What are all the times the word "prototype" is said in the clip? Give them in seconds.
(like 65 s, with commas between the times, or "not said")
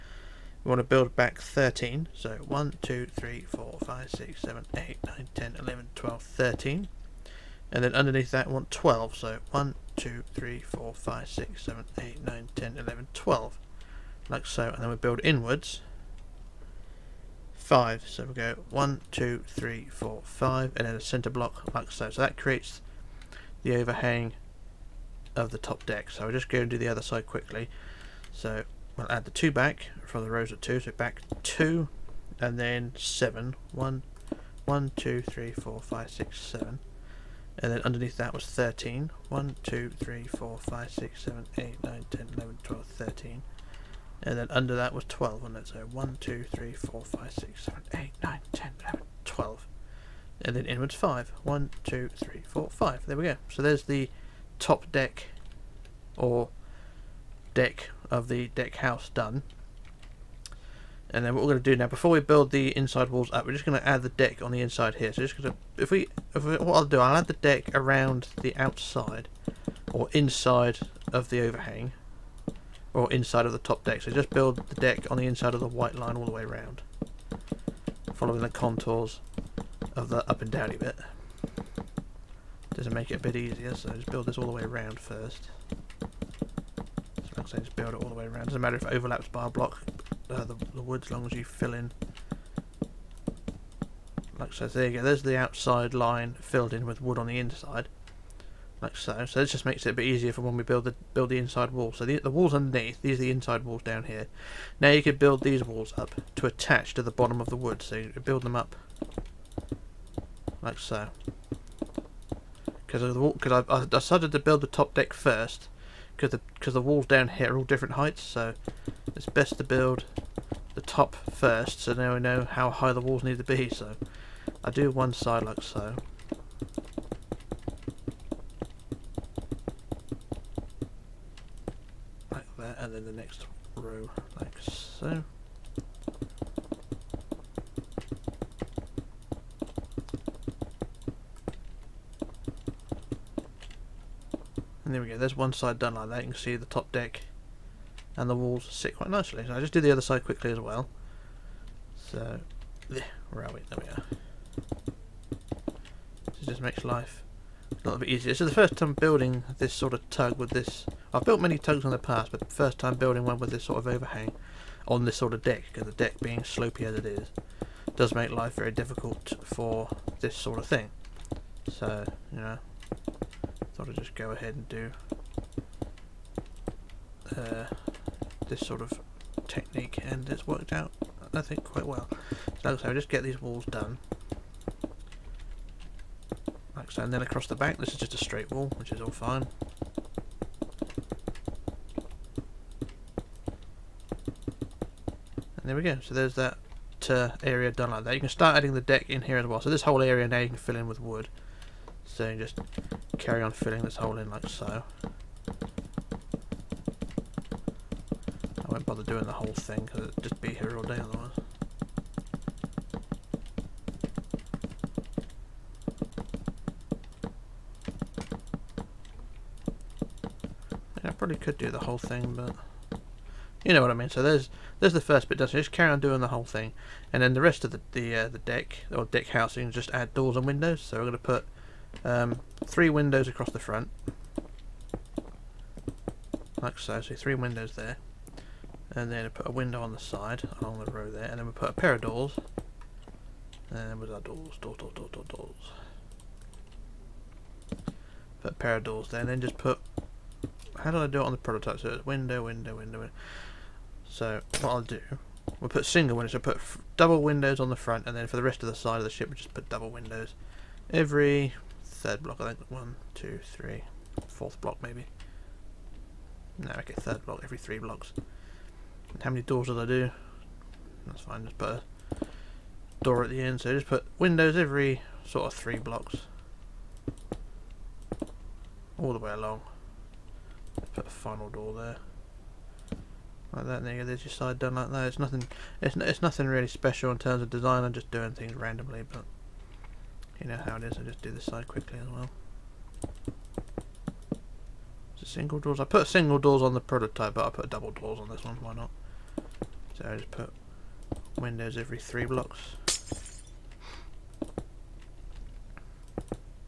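251 s, 296 s.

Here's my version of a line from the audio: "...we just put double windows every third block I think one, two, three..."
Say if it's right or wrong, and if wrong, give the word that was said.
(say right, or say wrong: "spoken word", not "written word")
right.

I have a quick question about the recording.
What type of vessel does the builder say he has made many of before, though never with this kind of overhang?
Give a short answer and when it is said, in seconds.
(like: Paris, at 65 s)
tugs, at 161 s.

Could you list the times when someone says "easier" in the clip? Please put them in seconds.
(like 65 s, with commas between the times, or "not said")
83 s, 100 s, 158 s.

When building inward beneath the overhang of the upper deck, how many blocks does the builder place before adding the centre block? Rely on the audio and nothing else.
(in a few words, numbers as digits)
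5.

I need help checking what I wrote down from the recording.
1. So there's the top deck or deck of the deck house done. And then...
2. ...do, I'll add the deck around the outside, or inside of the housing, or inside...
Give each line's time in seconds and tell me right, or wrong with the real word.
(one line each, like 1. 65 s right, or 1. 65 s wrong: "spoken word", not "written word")
1. 53 s right
2. 66 s wrong: "overhang", not "housing".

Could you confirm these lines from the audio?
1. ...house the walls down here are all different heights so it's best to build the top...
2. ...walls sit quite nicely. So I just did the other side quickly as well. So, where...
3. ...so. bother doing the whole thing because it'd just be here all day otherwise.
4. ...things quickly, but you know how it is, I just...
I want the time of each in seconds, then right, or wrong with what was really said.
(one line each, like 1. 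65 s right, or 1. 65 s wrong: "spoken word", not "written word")
1. 116 s wrong: "cause", not "house"
2. 148 s right
3. 204 s right
4. 288 s wrong: "randomly", not "quickly".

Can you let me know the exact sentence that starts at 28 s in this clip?
So we'll add the two back from the rows of two, so back two and then seven.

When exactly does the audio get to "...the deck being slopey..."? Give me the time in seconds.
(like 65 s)
165 s.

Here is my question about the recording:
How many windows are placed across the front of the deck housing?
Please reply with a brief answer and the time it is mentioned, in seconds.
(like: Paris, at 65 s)
3, at 232 s.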